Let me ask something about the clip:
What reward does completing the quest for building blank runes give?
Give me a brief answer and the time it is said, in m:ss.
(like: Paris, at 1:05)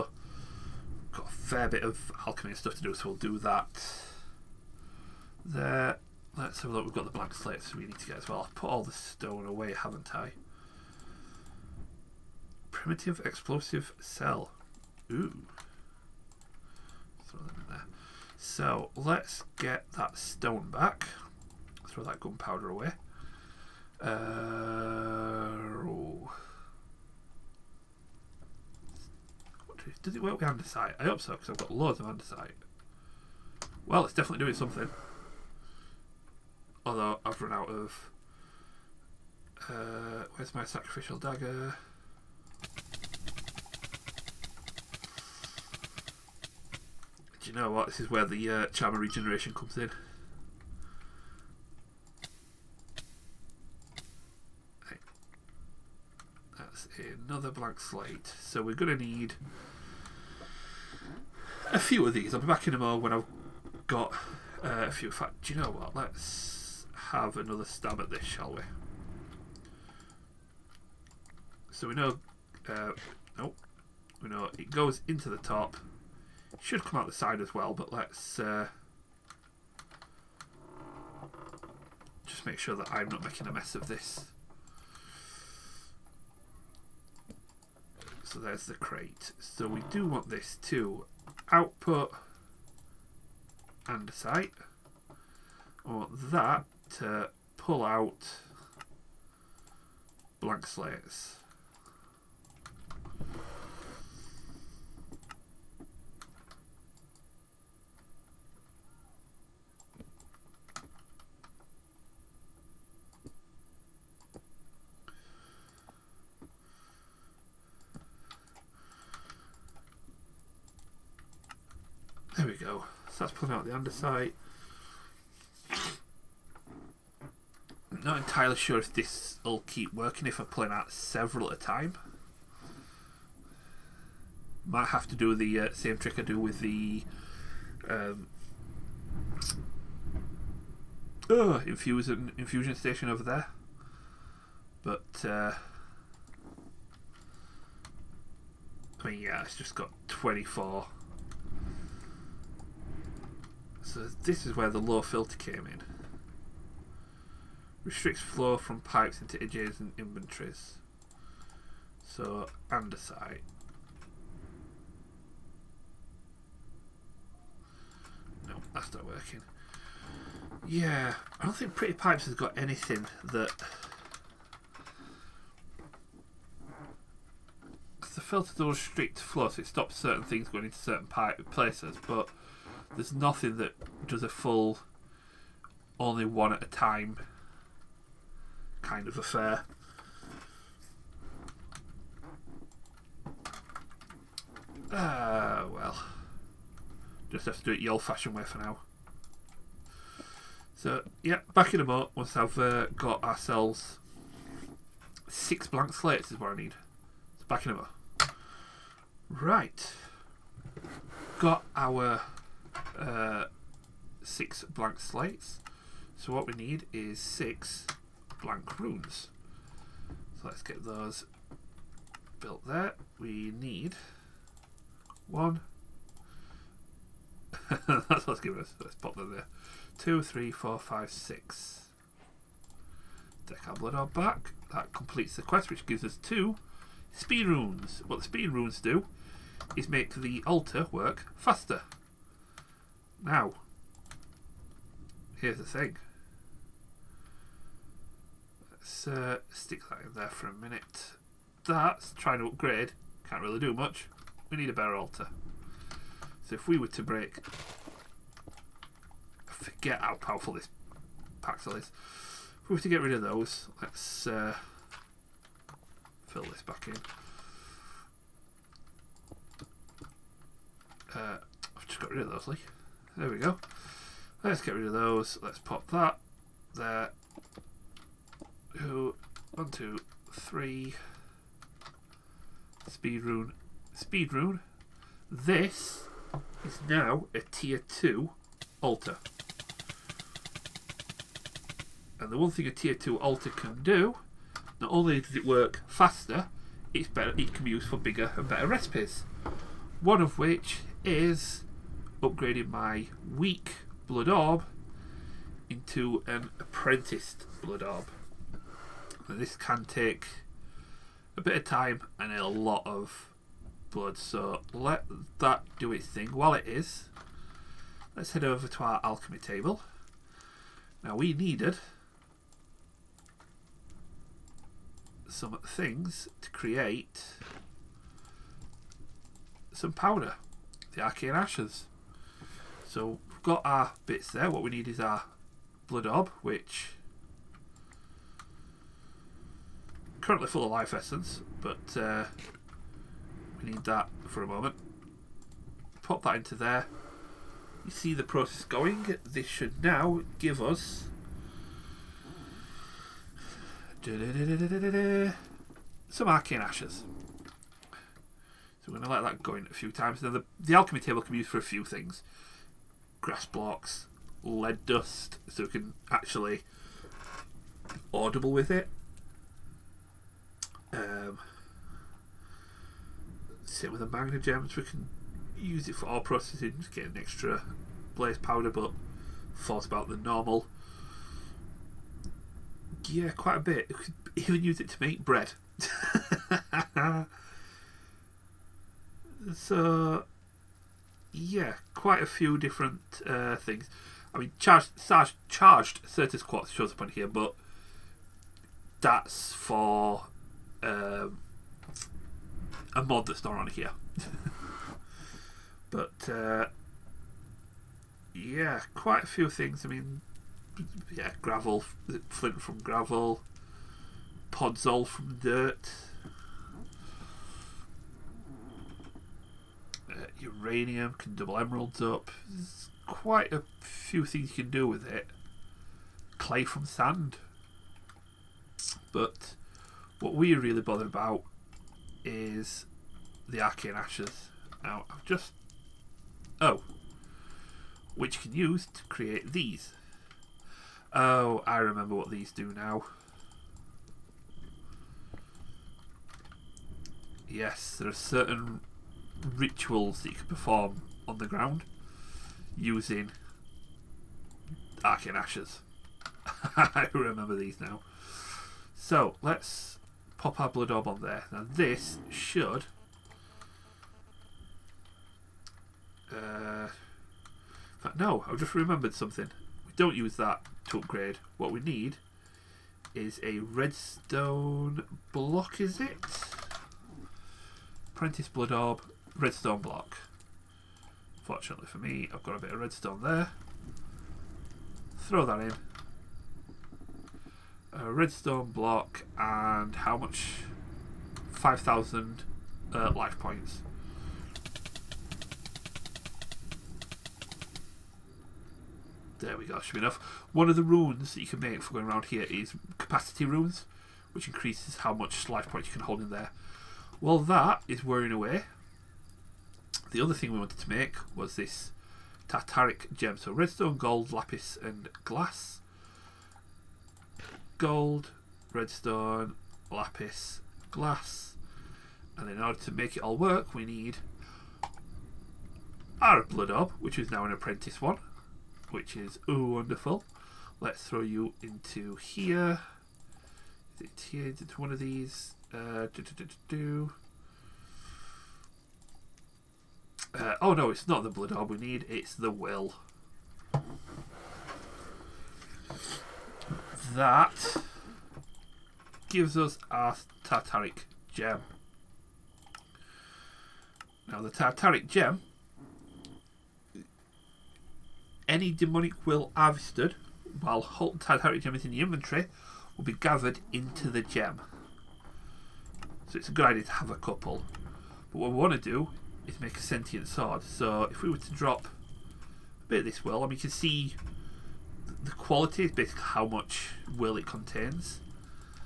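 two speed runes, at 3:56.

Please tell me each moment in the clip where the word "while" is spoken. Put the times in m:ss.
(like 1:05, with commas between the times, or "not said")
5:16, 9:20.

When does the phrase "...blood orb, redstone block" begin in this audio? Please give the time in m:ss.
7:58.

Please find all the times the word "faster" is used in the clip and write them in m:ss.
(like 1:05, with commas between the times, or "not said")
4:01, 4:55.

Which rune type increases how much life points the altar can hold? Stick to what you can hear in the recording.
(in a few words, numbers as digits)
capacity runes.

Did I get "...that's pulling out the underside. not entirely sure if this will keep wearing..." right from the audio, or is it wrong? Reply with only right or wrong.
wrong.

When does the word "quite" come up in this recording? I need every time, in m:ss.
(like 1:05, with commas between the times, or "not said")
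6:23, 6:31, 6:48, 7:03.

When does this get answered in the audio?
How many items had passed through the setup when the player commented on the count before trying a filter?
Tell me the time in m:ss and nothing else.
2:30.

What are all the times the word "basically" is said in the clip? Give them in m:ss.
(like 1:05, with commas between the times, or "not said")
9:35.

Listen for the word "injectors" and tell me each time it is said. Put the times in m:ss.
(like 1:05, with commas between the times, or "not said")
not said.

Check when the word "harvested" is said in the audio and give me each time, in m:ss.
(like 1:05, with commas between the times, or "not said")
9:19.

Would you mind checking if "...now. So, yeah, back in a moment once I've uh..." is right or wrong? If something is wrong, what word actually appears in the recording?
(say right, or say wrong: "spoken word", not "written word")
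right.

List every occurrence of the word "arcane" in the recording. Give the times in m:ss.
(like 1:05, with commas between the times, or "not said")
5:31, 5:56, 7:13, 7:35.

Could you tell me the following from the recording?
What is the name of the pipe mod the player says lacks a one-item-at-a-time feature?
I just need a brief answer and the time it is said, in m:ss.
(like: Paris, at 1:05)
Pretty Pipes, at 2:51.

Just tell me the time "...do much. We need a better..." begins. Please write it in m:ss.
4:13.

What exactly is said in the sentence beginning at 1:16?
should come out the side as well, but let's uh, just make sure that I'm not making a mess of this.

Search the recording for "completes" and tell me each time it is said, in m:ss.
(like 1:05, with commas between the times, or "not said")
3:54.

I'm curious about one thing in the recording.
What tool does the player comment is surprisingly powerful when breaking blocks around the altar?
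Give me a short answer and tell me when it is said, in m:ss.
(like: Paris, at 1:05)
Paxel, at 4:21.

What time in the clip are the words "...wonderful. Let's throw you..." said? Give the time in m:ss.
8:49.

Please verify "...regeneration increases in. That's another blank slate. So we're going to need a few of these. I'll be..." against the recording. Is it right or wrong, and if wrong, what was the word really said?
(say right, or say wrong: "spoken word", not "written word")
wrong: "comes", not "increases".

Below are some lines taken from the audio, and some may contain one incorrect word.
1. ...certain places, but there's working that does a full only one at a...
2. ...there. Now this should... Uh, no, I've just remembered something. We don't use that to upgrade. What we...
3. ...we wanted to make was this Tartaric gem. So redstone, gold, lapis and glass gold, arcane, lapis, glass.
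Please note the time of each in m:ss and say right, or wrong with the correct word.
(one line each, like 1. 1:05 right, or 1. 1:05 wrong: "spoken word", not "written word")
1. 3:00 wrong: "nothing", not "working"
2. 7:41 right
3. 8:30 wrong: "redstone", not "arcane".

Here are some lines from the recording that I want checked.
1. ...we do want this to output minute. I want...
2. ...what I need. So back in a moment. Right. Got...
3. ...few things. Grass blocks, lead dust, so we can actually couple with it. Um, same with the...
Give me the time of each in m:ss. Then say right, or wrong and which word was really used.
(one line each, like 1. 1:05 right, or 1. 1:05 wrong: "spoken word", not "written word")
1. 1:29 wrong: "andesite", not "minute"
2. 3:26 right
3. 6:01 wrong: "audible", not "couple".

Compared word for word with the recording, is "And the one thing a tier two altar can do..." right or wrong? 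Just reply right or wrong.
right.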